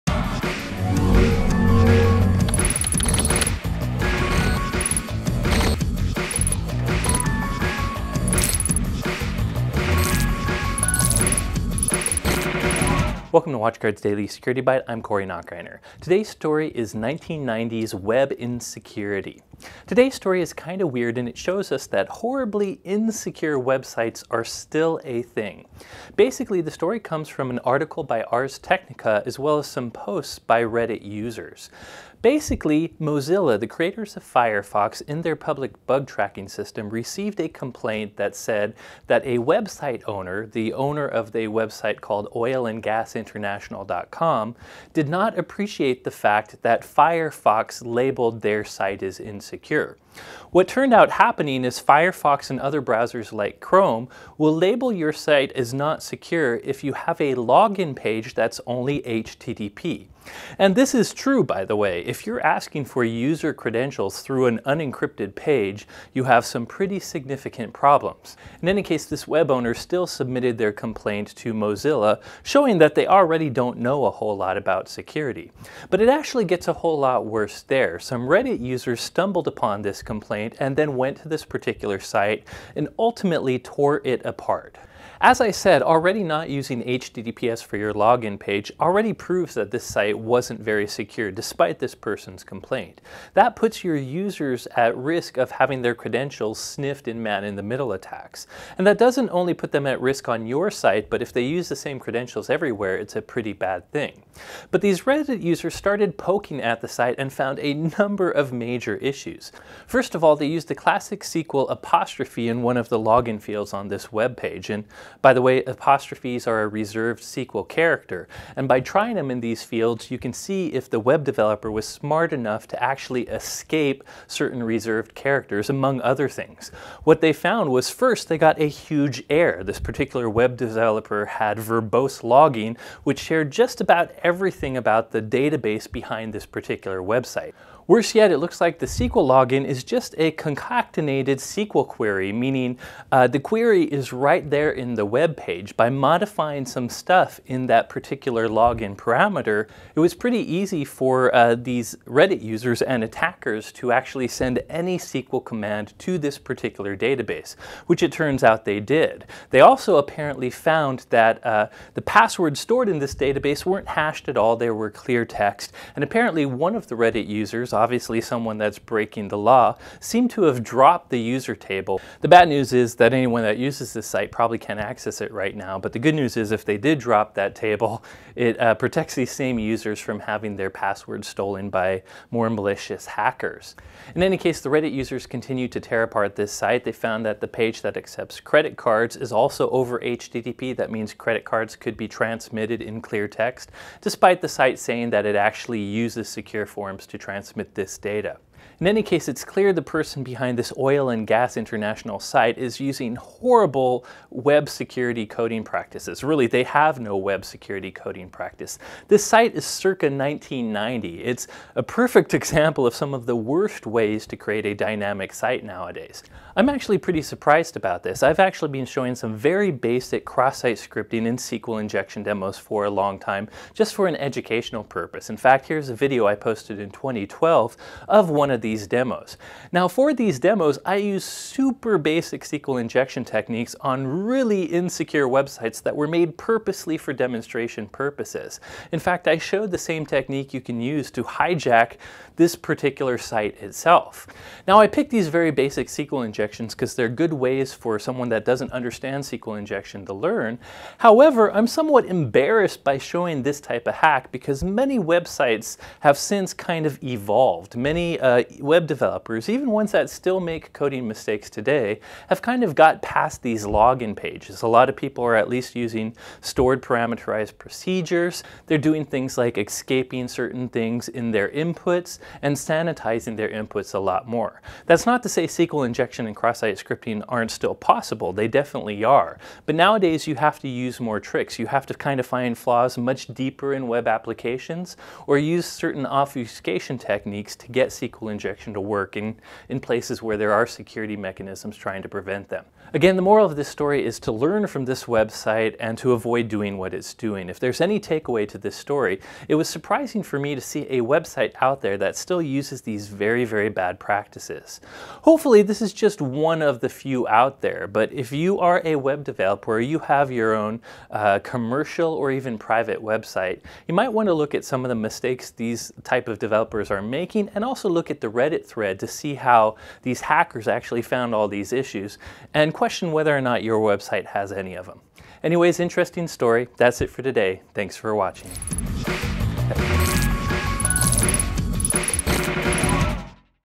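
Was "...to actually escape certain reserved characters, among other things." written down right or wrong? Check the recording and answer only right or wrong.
right.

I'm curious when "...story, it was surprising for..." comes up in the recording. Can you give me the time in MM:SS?
04:58.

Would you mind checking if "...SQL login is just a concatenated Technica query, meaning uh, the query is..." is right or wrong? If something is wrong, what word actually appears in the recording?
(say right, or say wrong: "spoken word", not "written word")
wrong: "SQL", not "Technica".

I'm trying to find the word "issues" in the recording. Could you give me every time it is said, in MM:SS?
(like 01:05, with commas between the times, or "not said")
01:48, 05:21.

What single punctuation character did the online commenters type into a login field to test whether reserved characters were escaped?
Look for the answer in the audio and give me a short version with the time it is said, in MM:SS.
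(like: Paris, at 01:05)
apostrophe, at 01:51.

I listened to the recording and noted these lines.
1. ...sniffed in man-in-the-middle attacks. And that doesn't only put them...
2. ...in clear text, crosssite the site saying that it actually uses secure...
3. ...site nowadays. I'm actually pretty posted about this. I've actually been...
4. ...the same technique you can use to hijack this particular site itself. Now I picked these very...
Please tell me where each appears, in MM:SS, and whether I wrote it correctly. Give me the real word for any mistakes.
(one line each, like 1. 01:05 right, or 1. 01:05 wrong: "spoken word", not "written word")
1. 01:36 right
2. 03:12 wrong: "despite", not "crosssite"
3. 03:35 wrong: "surprised", not "posted"
4. 03:59 right.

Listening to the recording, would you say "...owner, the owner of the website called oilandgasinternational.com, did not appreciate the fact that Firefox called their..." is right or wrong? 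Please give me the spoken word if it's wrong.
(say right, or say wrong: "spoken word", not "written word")
wrong: "labeled", not "called".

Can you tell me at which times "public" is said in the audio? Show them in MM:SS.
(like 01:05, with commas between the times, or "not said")
00:35.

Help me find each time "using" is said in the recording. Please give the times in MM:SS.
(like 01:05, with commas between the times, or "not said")
01:26, 03:22, 04:25.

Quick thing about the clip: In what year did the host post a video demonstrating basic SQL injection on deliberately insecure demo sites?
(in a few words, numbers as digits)
2012.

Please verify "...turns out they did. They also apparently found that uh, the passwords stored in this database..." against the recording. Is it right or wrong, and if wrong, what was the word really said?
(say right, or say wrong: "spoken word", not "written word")
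right.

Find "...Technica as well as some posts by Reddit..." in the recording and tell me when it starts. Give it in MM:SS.
00:28.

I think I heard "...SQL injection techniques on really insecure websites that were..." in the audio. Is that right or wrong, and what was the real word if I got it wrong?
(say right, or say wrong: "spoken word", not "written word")
right.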